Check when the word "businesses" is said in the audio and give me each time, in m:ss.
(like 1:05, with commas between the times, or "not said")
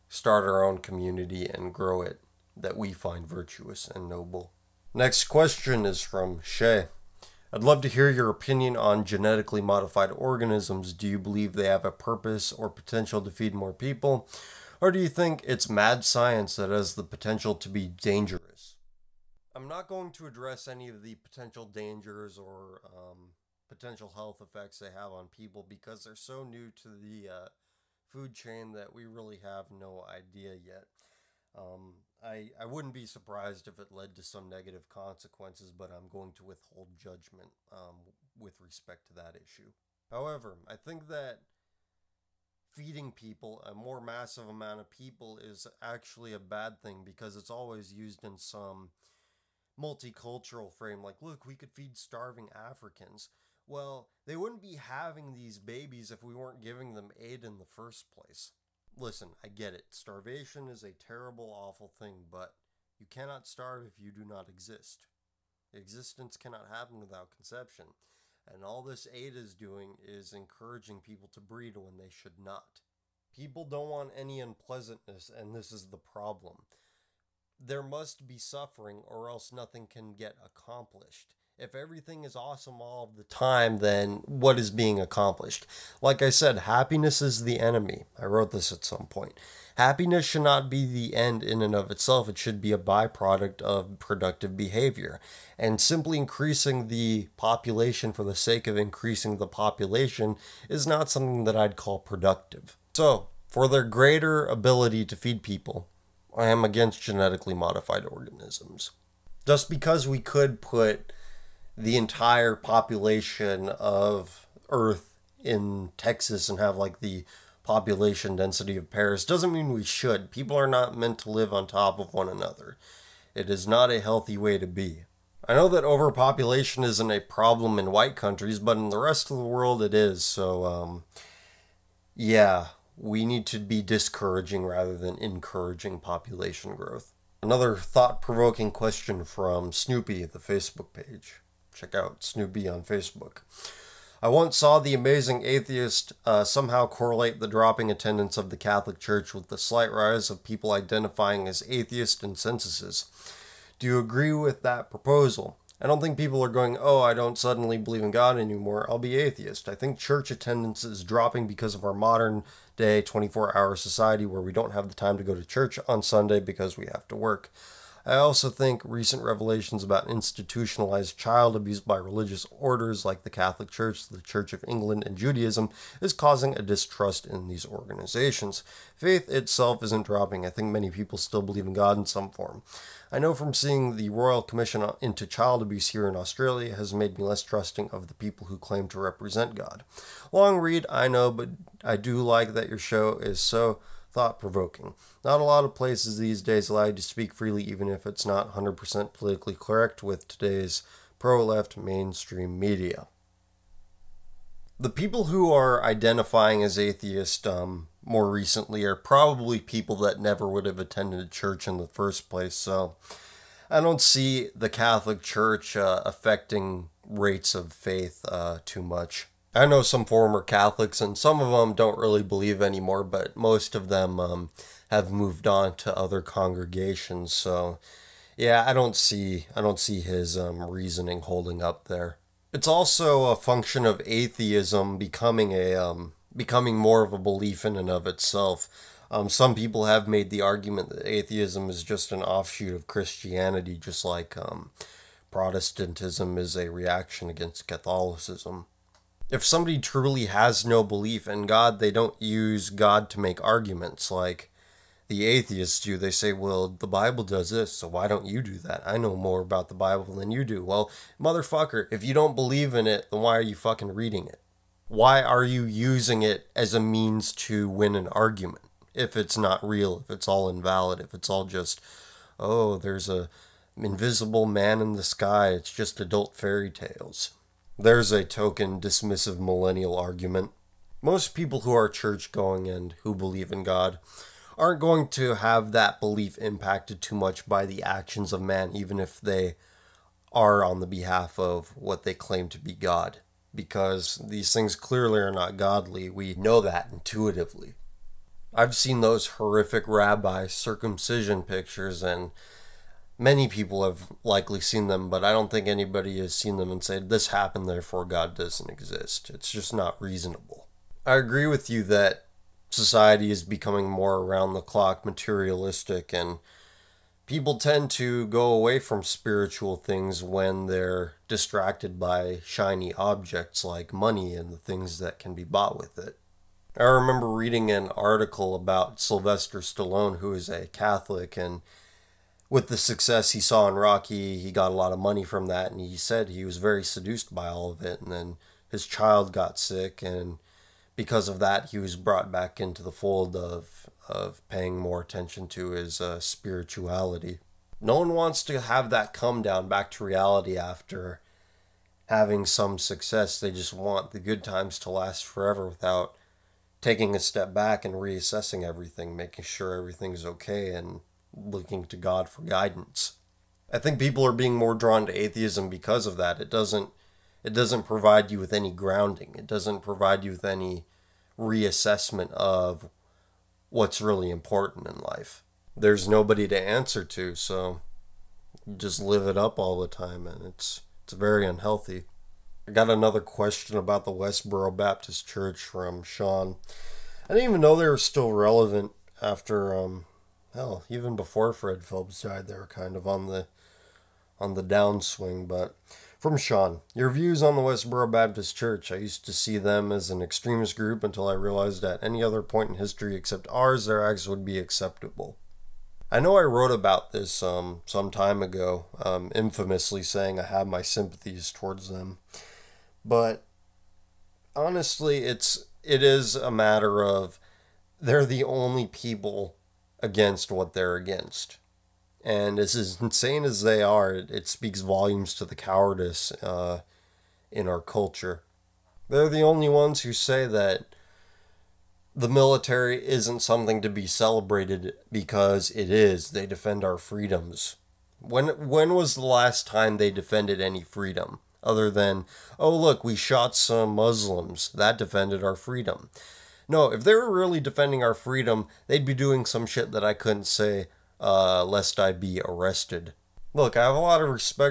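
not said.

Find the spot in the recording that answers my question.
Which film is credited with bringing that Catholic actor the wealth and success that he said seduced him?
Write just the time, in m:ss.
5:33.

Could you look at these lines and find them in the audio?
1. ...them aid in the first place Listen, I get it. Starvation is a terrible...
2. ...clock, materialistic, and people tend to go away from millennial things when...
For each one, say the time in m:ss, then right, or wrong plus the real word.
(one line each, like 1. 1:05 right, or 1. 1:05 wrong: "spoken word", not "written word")
1. 0:56 right
2. 5:14 wrong: "spiritual", not "millennial".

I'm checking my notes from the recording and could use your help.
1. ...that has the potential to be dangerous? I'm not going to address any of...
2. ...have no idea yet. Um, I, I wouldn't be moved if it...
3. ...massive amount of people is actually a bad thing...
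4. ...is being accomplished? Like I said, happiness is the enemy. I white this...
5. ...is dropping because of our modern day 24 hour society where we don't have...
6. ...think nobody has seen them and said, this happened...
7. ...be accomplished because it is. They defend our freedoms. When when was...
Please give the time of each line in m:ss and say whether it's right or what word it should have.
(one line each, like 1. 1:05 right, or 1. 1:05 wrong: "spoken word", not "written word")
1. 0:16 right
2. 0:29 wrong: "surprised", not "moved"
3. 0:43 right
4. 1:24 wrong: "wrote", not "white"
5. 2:40 right
6. 5:05 wrong: "anybody", not "nobody"
7. 7:13 wrong: "celebrated", not "accomplished".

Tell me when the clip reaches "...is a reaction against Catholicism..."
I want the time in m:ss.
4:06.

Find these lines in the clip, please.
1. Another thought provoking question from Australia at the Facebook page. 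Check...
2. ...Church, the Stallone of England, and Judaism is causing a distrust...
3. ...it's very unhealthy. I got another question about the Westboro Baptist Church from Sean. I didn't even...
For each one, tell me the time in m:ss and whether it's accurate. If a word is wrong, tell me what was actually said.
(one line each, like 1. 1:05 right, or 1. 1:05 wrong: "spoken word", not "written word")
1. 2:17 wrong: "Snoopy", not "Australia"
2. 2:53 wrong: "Church", not "Stallone"
3. 6:21 right.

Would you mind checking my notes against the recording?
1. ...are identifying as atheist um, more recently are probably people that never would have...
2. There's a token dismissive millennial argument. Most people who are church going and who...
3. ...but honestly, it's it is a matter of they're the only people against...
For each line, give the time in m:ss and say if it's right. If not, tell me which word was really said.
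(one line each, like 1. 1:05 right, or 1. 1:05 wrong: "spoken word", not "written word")
1. 3:25 right
2. 4:37 right
3. 6:53 right.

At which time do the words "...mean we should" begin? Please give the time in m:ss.
1:59.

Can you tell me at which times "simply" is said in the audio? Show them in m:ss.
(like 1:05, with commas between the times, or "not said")
1:35.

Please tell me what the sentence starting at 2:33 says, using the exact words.
Do you agree with that proposal?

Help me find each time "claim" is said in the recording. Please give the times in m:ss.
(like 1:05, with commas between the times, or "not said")
3:08, 4:52.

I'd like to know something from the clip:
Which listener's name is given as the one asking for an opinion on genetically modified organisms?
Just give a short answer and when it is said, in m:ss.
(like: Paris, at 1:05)
Shay, at 0:06.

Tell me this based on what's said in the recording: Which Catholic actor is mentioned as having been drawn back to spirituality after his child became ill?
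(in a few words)
Sylvester Stallone.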